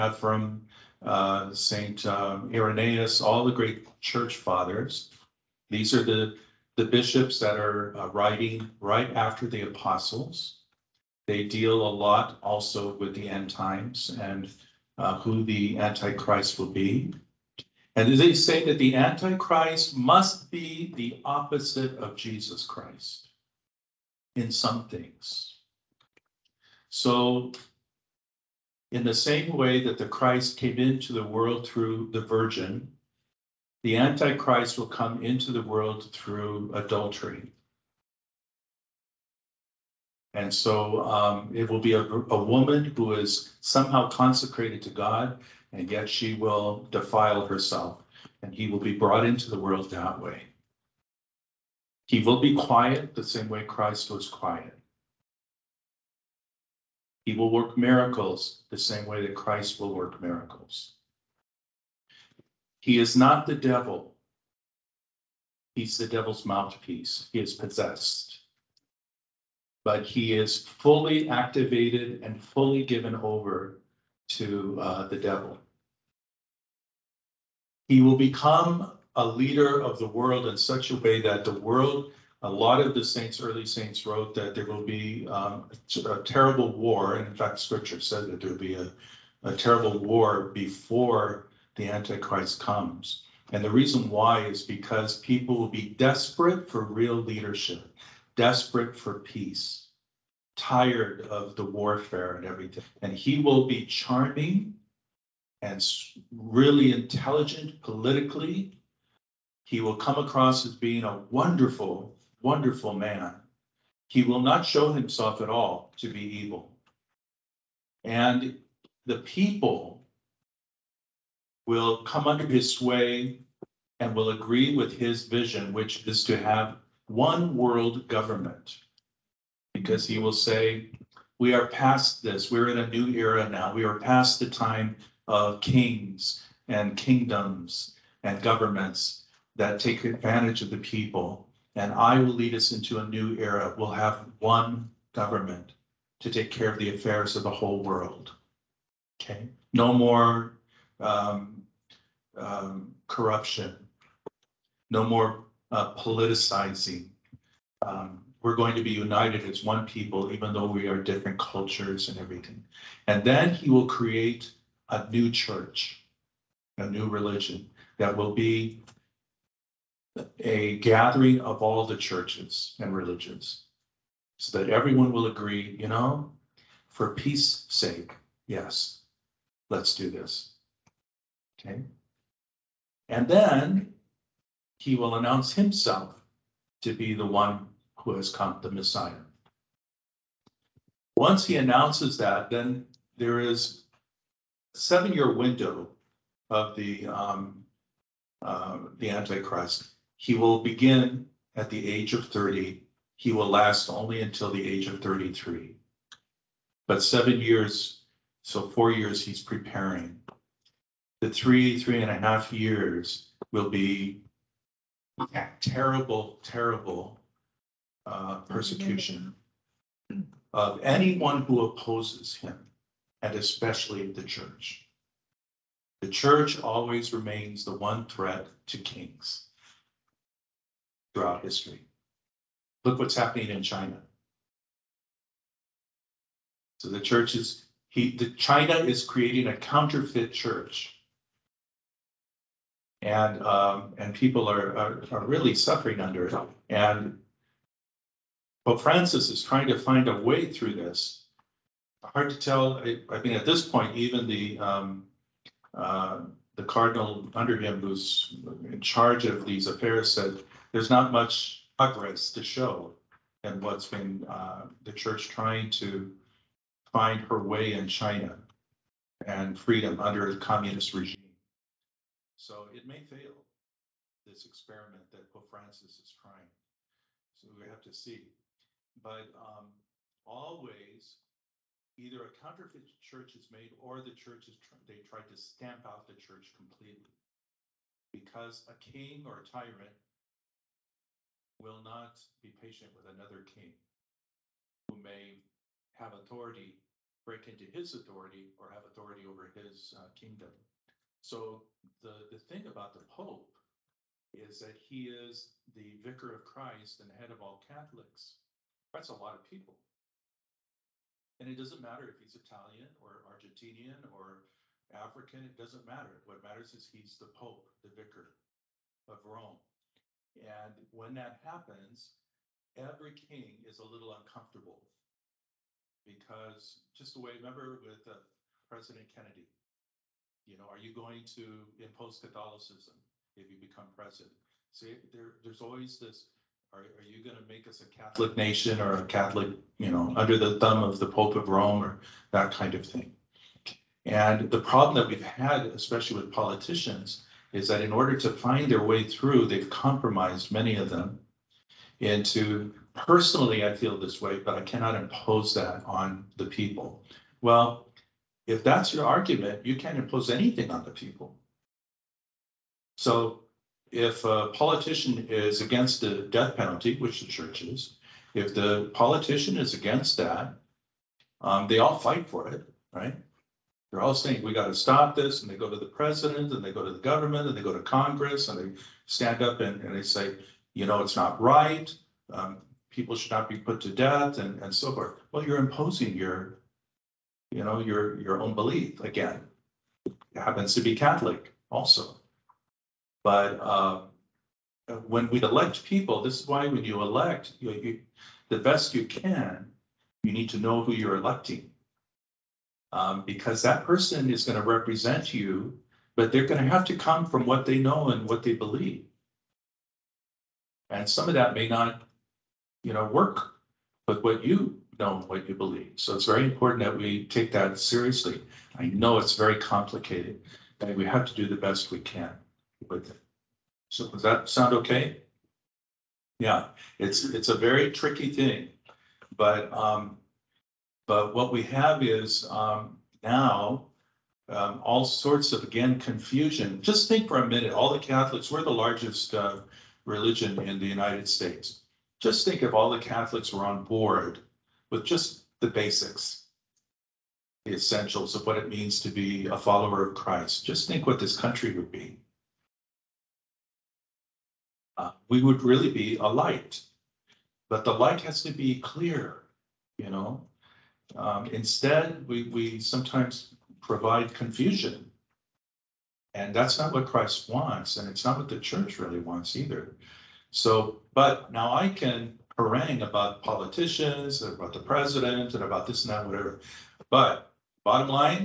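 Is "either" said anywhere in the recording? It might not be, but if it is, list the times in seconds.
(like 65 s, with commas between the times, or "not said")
281 s, 469 s.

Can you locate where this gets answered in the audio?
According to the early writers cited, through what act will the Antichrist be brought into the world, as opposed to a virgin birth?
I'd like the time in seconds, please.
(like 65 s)
36 s.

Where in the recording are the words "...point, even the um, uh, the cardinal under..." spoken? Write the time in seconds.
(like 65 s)
253 s.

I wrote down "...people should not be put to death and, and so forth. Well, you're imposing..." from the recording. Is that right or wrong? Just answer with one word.
right.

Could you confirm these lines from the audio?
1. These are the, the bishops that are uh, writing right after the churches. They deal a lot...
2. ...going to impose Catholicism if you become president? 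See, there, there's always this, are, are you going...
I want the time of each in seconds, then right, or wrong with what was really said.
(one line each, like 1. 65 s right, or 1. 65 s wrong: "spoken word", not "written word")
1. 5 s wrong: "apostles", not "churches"
2. 330 s right.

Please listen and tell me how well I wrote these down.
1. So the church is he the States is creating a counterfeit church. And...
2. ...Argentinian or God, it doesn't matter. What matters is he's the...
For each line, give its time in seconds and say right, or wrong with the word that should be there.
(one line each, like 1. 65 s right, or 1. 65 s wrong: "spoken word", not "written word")
1. 236 s wrong: "China", not "States"
2. 313 s wrong: "African", not "God".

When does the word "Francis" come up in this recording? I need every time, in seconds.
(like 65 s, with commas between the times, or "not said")
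248 s, 275 s.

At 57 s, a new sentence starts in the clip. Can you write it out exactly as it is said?
He will work miracles the same way that Christ will work miracles.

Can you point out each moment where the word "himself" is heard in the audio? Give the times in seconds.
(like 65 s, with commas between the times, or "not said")
114 s, 185 s.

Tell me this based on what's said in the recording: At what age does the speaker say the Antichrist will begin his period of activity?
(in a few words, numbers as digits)
30.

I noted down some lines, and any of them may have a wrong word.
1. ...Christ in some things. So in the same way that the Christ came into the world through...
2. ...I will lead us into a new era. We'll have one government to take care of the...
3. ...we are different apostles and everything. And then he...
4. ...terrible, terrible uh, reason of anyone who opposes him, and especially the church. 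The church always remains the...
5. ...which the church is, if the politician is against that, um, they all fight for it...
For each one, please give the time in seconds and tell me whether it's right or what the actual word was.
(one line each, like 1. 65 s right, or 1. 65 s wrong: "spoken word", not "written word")
1. 22 s right
2. 141 s right
3. 160 s wrong: "cultures", not "apostles"
4. 215 s wrong: "persecution", not "reason"
5. 366 s right.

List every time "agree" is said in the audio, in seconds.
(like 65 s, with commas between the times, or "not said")
124 s, 175 s.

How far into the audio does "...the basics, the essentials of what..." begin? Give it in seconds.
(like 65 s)
445 s.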